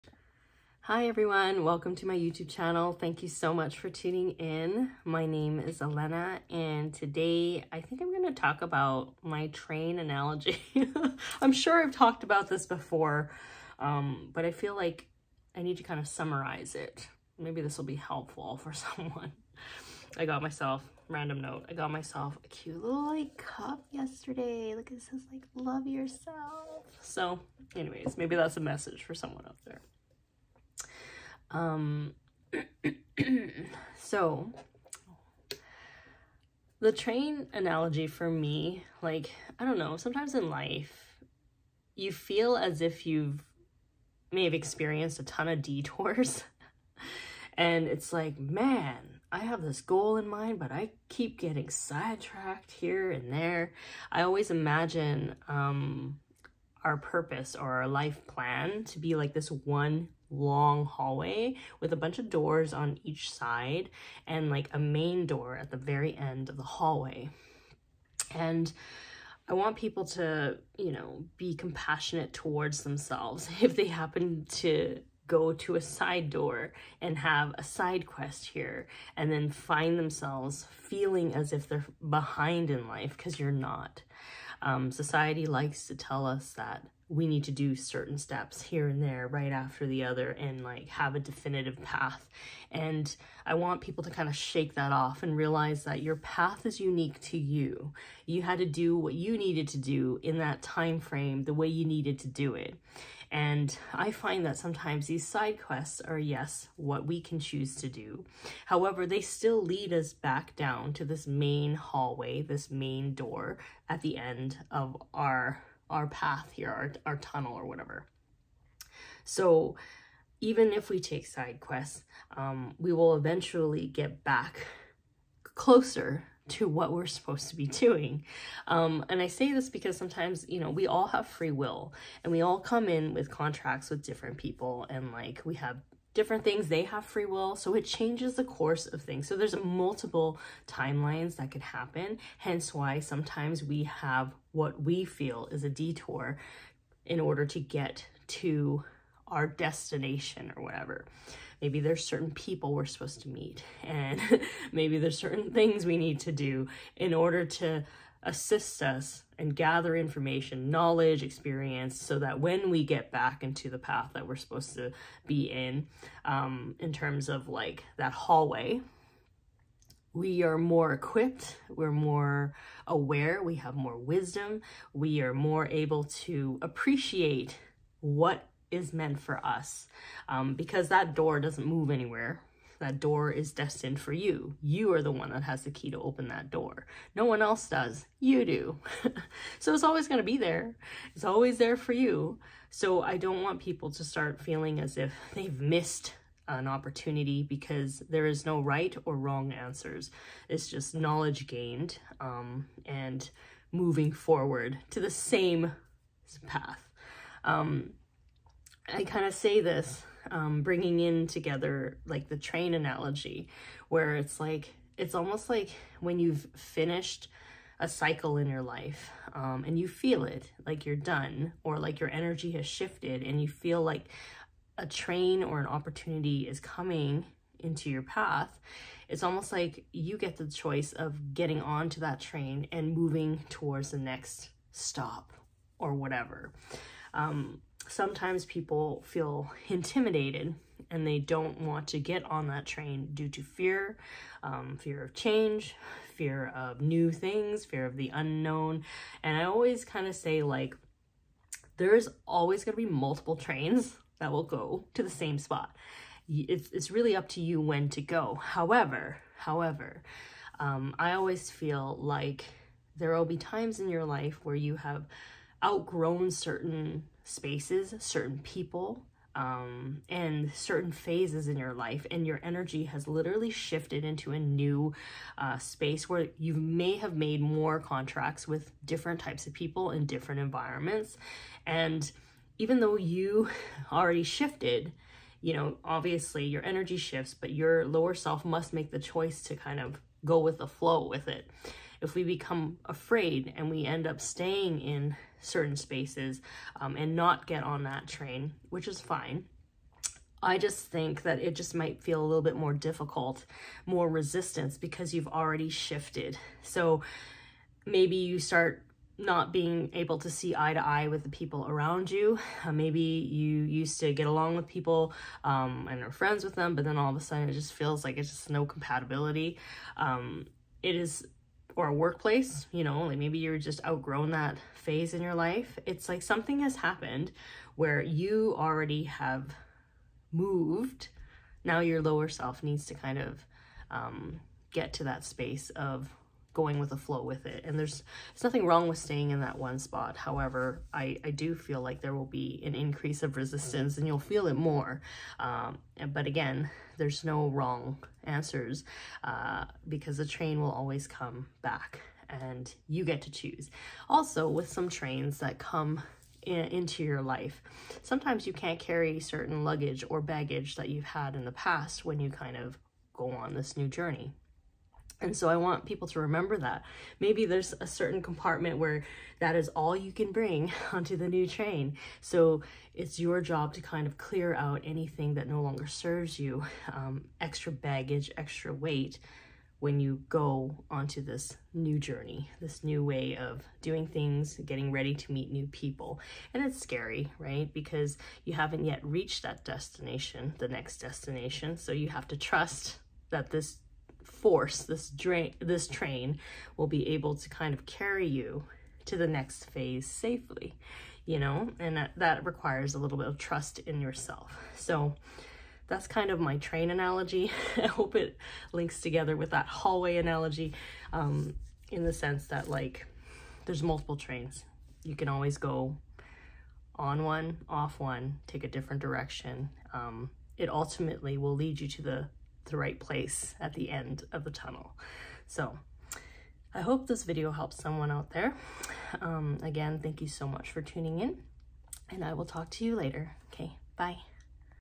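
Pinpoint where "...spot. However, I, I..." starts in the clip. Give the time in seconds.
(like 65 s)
339 s.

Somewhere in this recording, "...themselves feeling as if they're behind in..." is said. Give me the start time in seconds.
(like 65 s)
79 s.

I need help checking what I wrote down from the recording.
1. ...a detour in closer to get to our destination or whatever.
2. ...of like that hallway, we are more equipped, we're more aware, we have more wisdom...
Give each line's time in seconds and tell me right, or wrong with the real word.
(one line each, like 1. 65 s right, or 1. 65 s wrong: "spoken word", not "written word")
1. 145 s wrong: "order", not "closer"
2. 167 s right.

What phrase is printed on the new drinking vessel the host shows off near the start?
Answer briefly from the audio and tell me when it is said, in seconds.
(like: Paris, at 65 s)
love yourself, at 25 s.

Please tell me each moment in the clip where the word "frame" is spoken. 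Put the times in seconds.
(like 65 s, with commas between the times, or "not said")
101 s.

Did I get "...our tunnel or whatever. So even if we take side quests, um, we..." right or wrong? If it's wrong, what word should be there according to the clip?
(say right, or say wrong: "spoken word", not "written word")
right.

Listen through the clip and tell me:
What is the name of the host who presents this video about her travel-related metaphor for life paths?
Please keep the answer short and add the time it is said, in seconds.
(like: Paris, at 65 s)
Elena, at 5 s.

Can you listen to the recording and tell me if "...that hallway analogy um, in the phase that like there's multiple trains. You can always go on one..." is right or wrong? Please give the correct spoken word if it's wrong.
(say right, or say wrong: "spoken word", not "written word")
wrong: "sense", not "phase".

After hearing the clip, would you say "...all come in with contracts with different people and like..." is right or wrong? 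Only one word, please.
right.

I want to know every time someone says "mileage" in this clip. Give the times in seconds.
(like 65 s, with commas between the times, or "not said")
not said.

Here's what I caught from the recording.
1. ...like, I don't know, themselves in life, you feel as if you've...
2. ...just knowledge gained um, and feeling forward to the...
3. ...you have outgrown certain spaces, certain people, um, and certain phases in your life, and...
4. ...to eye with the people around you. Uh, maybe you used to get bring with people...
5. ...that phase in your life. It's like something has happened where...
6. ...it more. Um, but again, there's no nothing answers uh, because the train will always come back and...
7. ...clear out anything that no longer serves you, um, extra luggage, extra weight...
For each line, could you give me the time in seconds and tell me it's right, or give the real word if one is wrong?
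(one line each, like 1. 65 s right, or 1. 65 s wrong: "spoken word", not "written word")
1. 39 s wrong: "sometimes", not "themselves"
2. 200 s wrong: "moving", not "feeling"
3. 264 s right
4. 310 s wrong: "along", not "bring"
5. 324 s right
6. 344 s wrong: "wrong", not "nothing"
7. 374 s wrong: "baggage", not "luggage".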